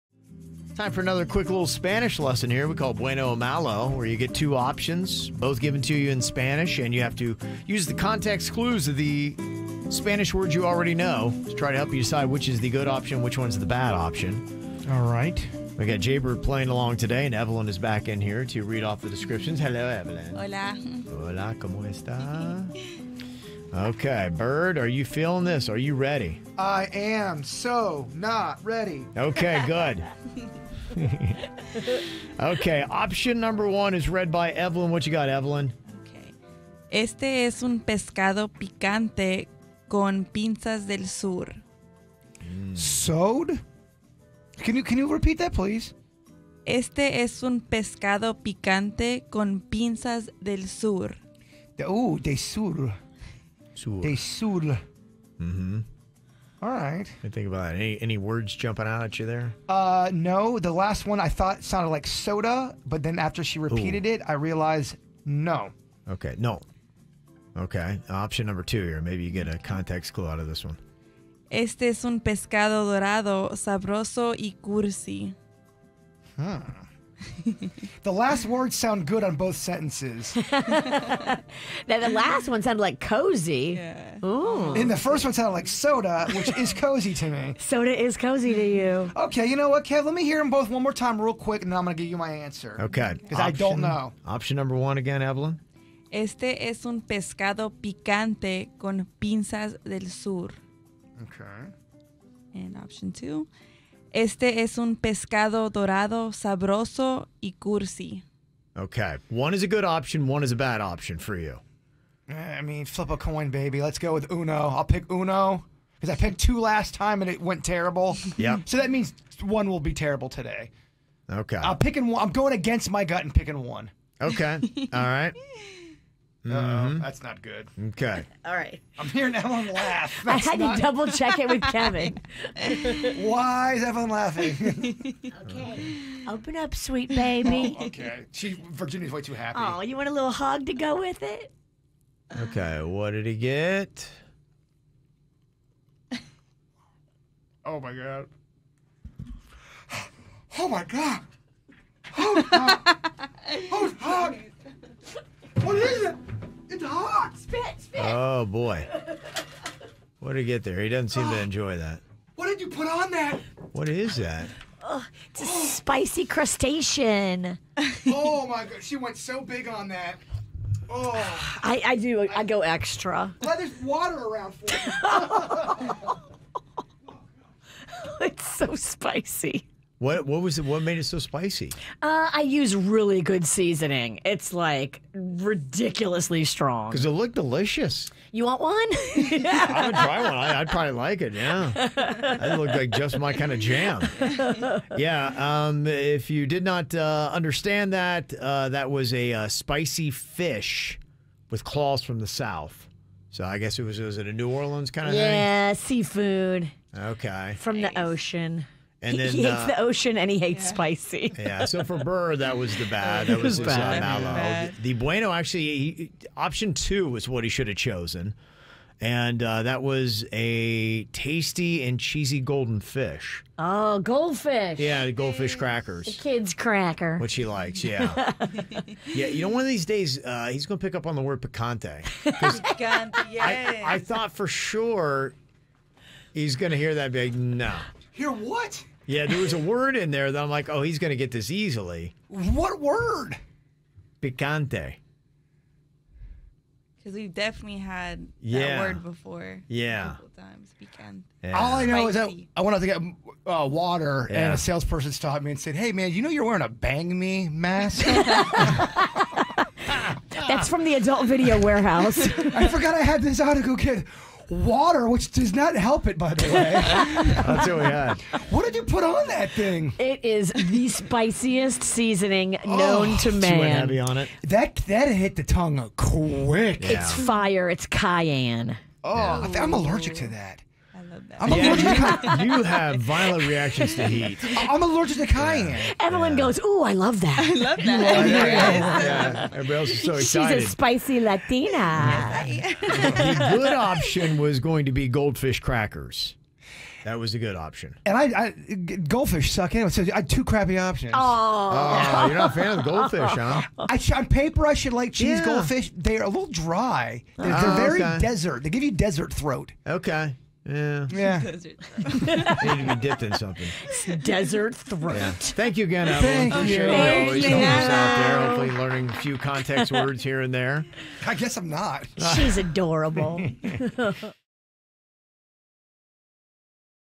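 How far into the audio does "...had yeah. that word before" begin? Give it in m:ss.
4:07.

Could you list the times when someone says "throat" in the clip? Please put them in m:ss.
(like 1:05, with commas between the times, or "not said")
5:09, 5:14.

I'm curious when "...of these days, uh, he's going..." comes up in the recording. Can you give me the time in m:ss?
3:49.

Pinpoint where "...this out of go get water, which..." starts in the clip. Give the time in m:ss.
4:23.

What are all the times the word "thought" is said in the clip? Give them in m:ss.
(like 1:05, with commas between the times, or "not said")
1:01, 3:53.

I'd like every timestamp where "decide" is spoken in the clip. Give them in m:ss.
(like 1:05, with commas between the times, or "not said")
0:11.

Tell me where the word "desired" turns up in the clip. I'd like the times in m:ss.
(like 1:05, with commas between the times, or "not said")
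not said.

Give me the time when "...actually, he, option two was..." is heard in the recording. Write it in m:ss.
3:35.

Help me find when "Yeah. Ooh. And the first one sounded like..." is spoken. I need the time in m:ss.
1:23.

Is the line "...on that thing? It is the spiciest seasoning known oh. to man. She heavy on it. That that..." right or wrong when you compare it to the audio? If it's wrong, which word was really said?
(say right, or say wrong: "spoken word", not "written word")
right.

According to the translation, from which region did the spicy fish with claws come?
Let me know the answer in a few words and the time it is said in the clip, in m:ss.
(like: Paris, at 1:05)
the south, at 3:22.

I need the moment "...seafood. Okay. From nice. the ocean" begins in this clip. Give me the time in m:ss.
3:25.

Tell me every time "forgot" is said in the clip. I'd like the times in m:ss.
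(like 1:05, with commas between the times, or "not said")
4:22.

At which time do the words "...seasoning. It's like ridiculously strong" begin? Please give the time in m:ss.
3:03.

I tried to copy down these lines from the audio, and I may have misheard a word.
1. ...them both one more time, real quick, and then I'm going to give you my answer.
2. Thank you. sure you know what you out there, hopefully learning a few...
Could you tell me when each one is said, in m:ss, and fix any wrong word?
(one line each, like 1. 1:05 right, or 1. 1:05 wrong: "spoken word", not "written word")
1. 1:30 right
2. 5:16 right.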